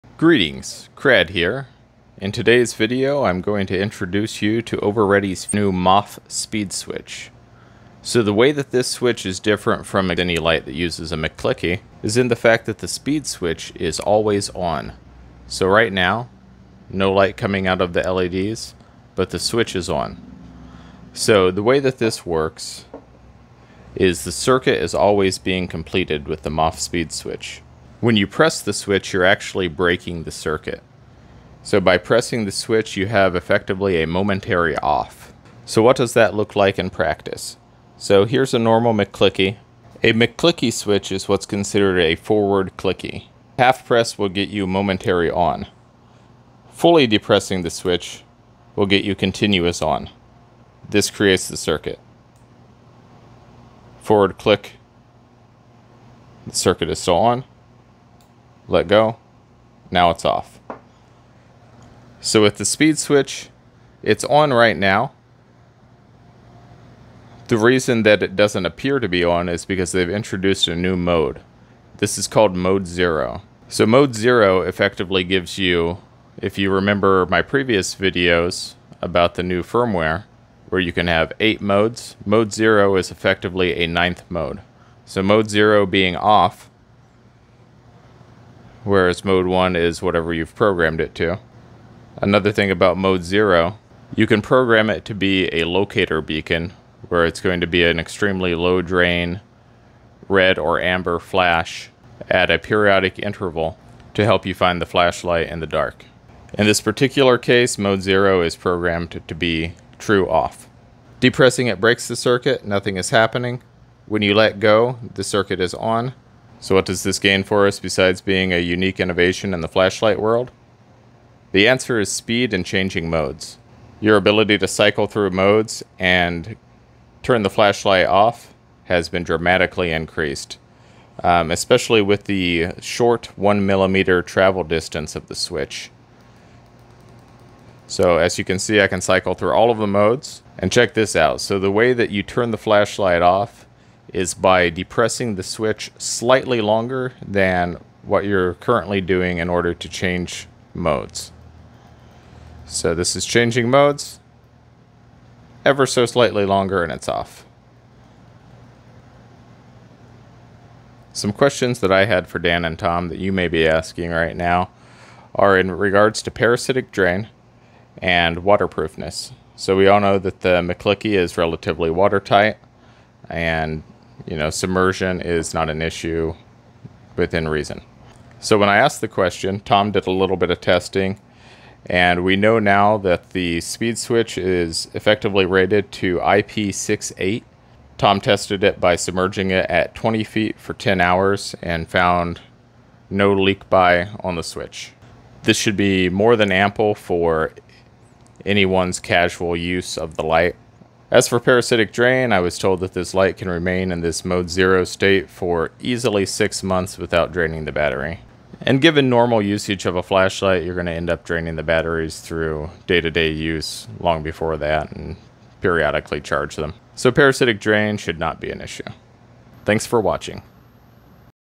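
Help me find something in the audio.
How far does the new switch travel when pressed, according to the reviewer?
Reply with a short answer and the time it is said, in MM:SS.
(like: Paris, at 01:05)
1 millimeter, at 02:13.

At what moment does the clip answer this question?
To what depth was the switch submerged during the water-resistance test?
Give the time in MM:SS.
03:09.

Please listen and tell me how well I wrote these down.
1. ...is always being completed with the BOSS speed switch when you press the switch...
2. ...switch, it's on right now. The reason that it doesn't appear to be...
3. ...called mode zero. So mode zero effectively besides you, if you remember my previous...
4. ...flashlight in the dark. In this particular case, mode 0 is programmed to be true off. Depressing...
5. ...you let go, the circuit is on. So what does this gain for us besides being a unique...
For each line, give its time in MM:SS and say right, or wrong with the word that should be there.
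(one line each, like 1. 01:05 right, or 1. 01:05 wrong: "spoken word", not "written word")
1. 00:24 right
2. 01:02 right
3. 01:12 wrong: "gives", not "besides"
4. 01:44 right
5. 01:54 right.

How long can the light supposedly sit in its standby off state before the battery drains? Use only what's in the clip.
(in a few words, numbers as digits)
6 months.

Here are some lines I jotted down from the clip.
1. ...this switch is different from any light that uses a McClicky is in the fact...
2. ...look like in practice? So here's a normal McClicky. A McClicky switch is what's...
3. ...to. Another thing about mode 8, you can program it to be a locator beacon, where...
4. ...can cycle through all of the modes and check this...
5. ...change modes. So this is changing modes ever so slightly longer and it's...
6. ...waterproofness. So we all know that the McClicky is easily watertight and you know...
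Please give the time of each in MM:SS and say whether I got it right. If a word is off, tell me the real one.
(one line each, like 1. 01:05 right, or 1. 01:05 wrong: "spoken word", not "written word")
1. 00:08 right
2. 00:36 right
3. 01:31 wrong: "0", not "8"
4. 02:18 right
5. 02:29 right
6. 02:48 wrong: "relatively", not "easily".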